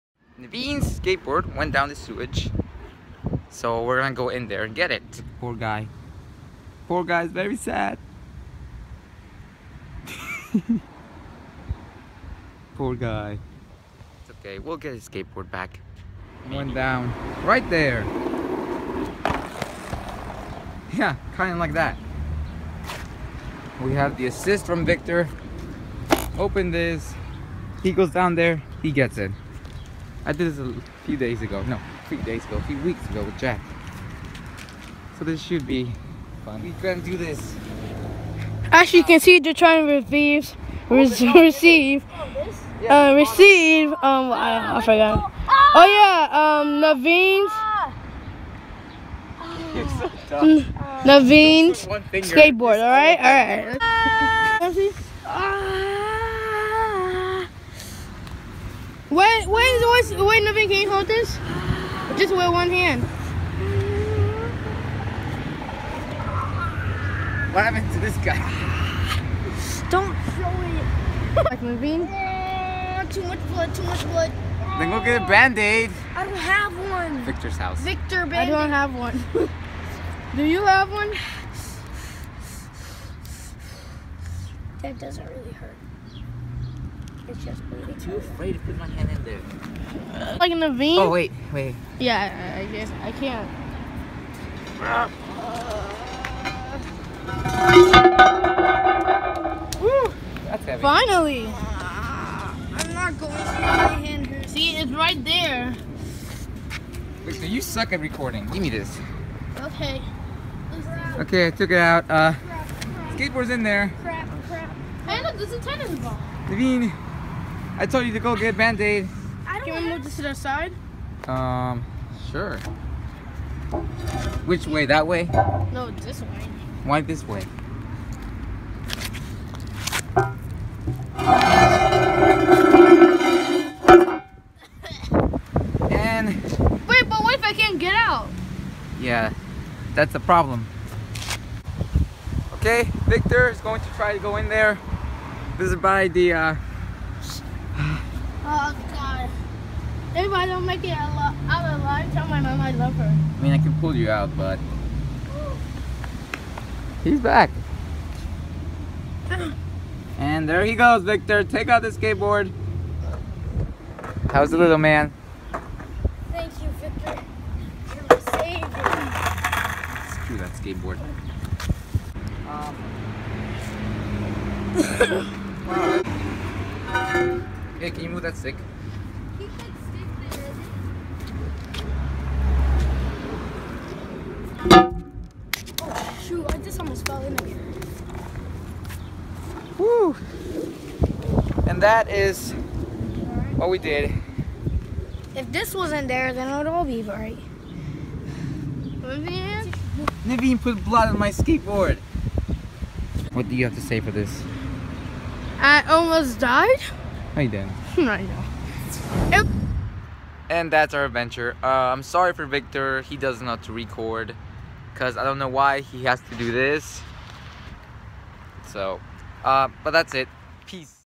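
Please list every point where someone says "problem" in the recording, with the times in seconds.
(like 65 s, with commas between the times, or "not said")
140 s.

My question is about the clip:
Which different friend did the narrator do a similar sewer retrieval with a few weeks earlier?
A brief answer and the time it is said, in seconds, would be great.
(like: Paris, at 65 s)
Jack, at 33 s.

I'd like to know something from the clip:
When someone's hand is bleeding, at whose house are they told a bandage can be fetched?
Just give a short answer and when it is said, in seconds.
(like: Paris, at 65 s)
Victor's house, at 77 s.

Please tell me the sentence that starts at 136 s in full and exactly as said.
Wait, but what if I can't get out?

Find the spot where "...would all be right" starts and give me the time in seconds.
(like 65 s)
196 s.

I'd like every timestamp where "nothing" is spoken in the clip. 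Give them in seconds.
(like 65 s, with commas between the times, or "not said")
60 s.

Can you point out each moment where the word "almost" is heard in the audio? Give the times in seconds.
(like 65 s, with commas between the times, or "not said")
186 s, 205 s.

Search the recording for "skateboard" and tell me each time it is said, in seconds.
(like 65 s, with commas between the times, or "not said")
0 s, 15 s, 52 s, 113 s, 161 s, 170 s, 201 s.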